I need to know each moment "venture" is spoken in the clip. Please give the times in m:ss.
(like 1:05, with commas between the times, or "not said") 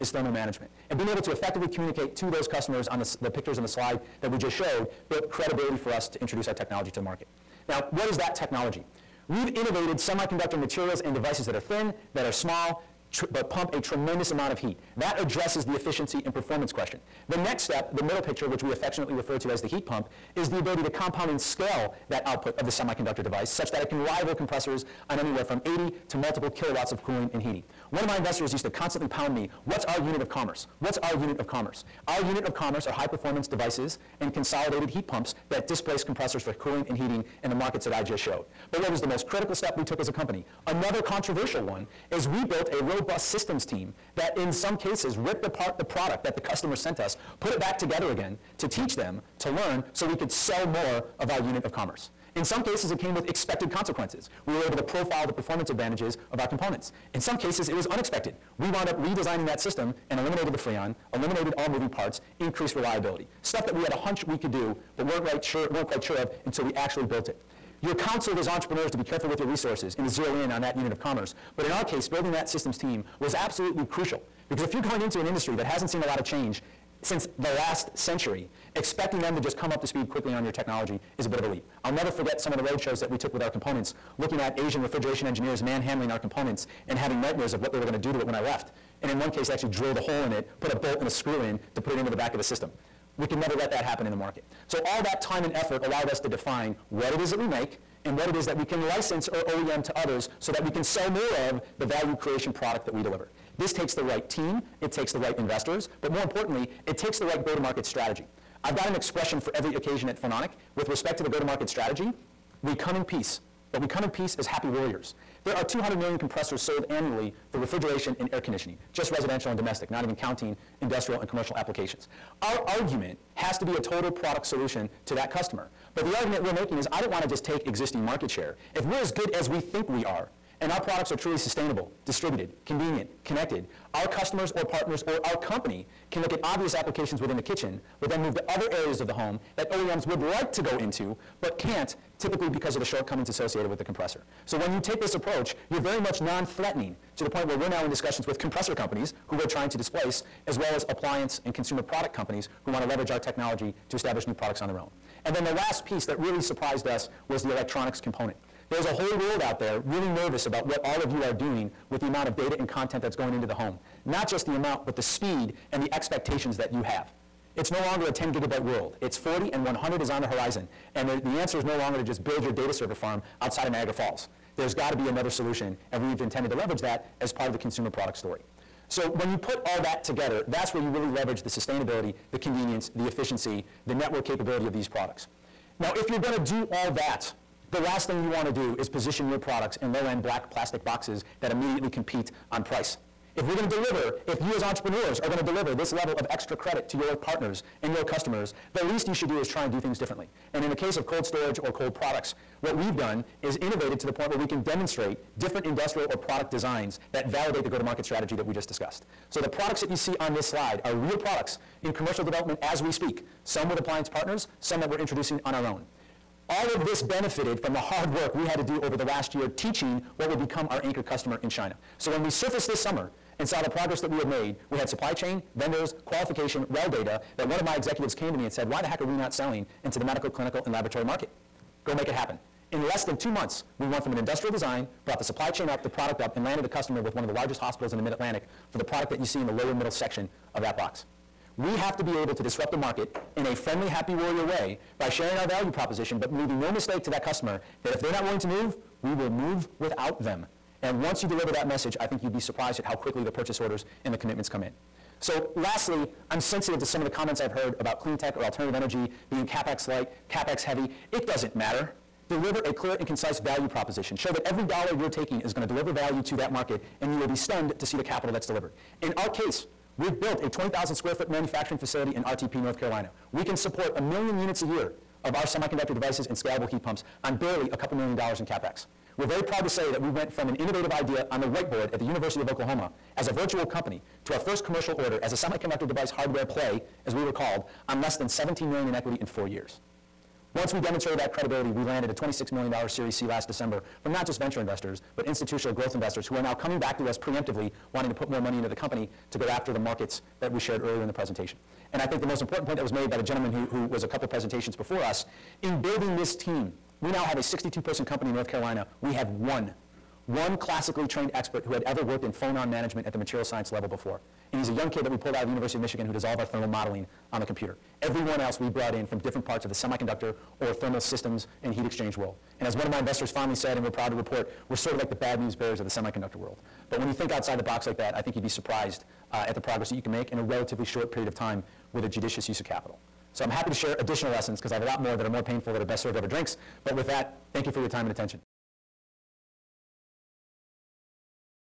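4:54.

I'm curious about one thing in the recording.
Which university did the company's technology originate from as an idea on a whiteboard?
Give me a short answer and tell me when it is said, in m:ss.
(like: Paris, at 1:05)
University of Oklahoma, at 4:42.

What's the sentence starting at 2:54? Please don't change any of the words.
There's got to be another solution, and we have intended to leverage that as part of the consumer product story.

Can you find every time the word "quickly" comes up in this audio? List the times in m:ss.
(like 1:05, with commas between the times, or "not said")
1:20, 4:12.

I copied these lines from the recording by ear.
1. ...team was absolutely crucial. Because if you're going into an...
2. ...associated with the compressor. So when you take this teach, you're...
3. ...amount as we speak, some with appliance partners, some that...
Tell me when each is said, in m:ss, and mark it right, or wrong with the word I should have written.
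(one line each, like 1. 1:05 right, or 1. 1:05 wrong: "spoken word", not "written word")
1. 1:12 right
2. 2:23 wrong: "approach", not "teach"
3. 3:32 wrong: "development", not "amount".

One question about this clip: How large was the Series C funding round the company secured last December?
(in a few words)
$26 million.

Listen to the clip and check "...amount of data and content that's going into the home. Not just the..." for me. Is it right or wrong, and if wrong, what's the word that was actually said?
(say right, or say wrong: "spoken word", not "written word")
right.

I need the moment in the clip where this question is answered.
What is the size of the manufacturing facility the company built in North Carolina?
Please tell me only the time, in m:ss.
4:30.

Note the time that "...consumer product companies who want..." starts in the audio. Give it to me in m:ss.
2:31.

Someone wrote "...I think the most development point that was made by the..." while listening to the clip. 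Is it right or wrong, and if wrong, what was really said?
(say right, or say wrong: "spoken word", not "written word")
wrong: "important", not "development".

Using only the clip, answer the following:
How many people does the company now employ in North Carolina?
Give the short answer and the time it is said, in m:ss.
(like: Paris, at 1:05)
62, at 5:07.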